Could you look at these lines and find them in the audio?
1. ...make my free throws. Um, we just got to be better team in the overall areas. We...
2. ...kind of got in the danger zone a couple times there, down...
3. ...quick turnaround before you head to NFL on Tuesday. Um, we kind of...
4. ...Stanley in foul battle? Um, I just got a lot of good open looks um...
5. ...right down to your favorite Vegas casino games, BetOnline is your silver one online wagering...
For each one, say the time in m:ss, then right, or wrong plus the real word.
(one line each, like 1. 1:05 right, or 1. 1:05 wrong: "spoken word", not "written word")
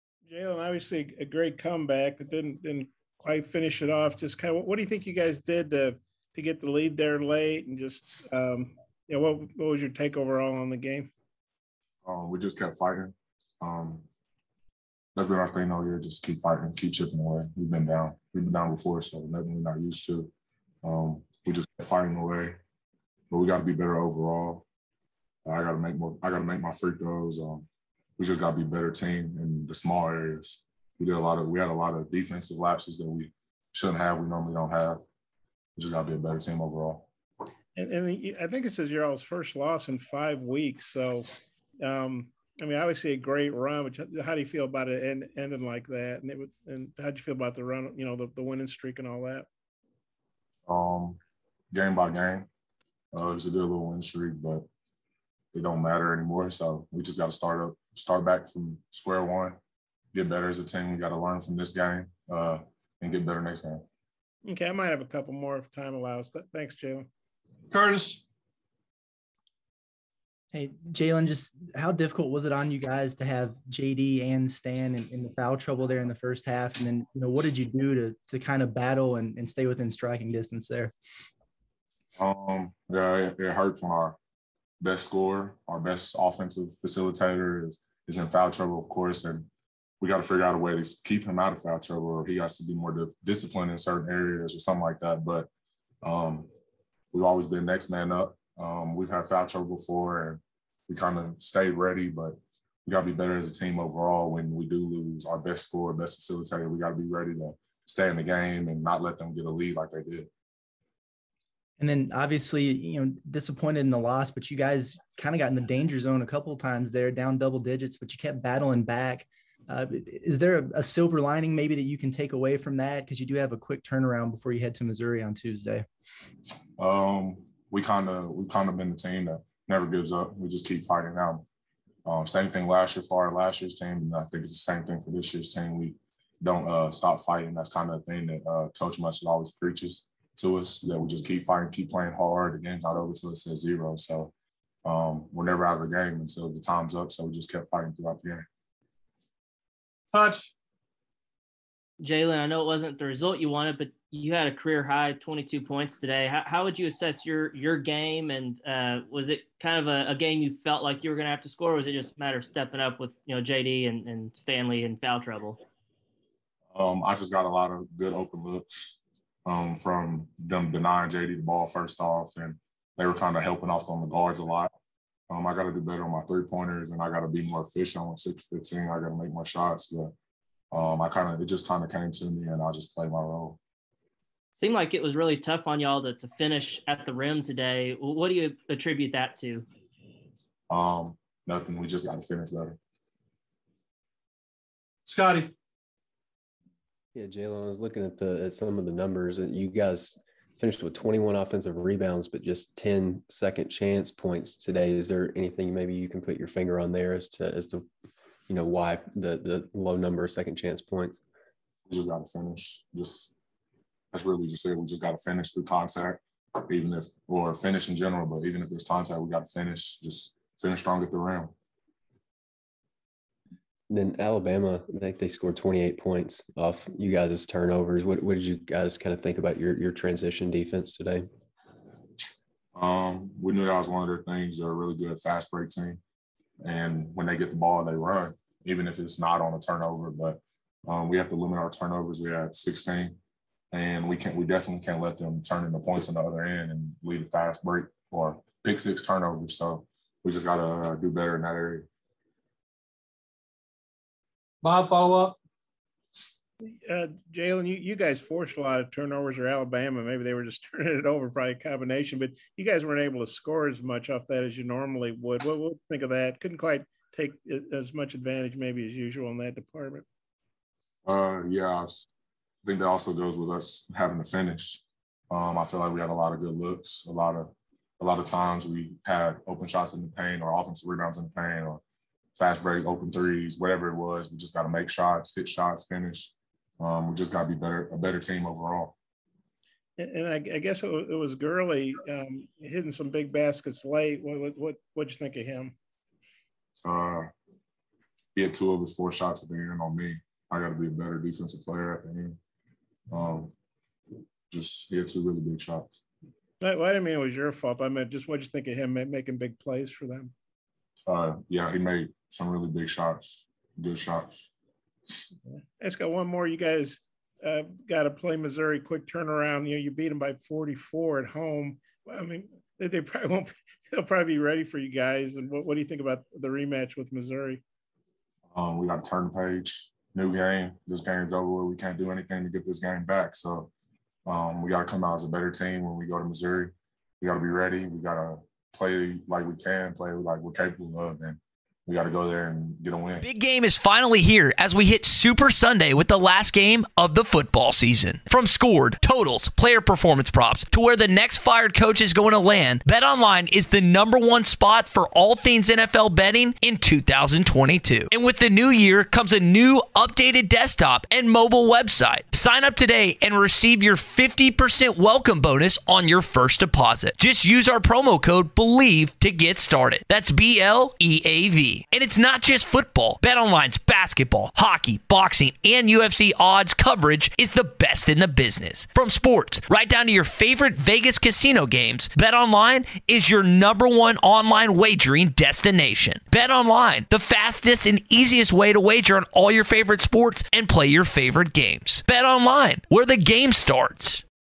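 1. 0:26 wrong: "small", not "overall"
2. 1:55 right
3. 2:03 wrong: "Missouri", not "NFL"
4. 2:44 wrong: "trouble", not "battle"
5. 6:19 wrong: "number", not "silver".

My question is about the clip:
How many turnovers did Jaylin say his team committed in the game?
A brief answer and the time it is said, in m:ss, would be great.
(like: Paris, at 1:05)
16, at 4:02.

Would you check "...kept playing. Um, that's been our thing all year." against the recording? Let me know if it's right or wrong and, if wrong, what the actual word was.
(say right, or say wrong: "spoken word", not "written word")
wrong: "fighting", not "playing".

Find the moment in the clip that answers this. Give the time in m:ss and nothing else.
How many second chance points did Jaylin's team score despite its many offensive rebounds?
3:22.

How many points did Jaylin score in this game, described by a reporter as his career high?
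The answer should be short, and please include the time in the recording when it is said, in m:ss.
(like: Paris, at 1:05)
22, at 2:35.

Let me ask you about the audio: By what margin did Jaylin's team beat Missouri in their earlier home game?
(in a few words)
44.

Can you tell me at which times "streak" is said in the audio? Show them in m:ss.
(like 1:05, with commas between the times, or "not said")
0:48, 0:54.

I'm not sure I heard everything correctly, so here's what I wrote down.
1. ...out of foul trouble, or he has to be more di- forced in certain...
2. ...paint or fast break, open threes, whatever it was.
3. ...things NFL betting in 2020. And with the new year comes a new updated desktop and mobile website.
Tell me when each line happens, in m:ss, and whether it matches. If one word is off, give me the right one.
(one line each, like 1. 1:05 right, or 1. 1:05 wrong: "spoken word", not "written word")
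1. 1:31 wrong: "disciplined", not "forced"
2. 4:41 right
3. 5:55 wrong: "2022", not "2020".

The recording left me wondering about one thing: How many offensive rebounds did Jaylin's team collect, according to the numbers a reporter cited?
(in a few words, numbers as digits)
21.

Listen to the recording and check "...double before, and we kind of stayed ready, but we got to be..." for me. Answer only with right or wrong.
wrong.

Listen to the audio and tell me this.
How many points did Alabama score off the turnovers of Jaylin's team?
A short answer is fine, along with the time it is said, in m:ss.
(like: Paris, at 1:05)
28, at 3:45.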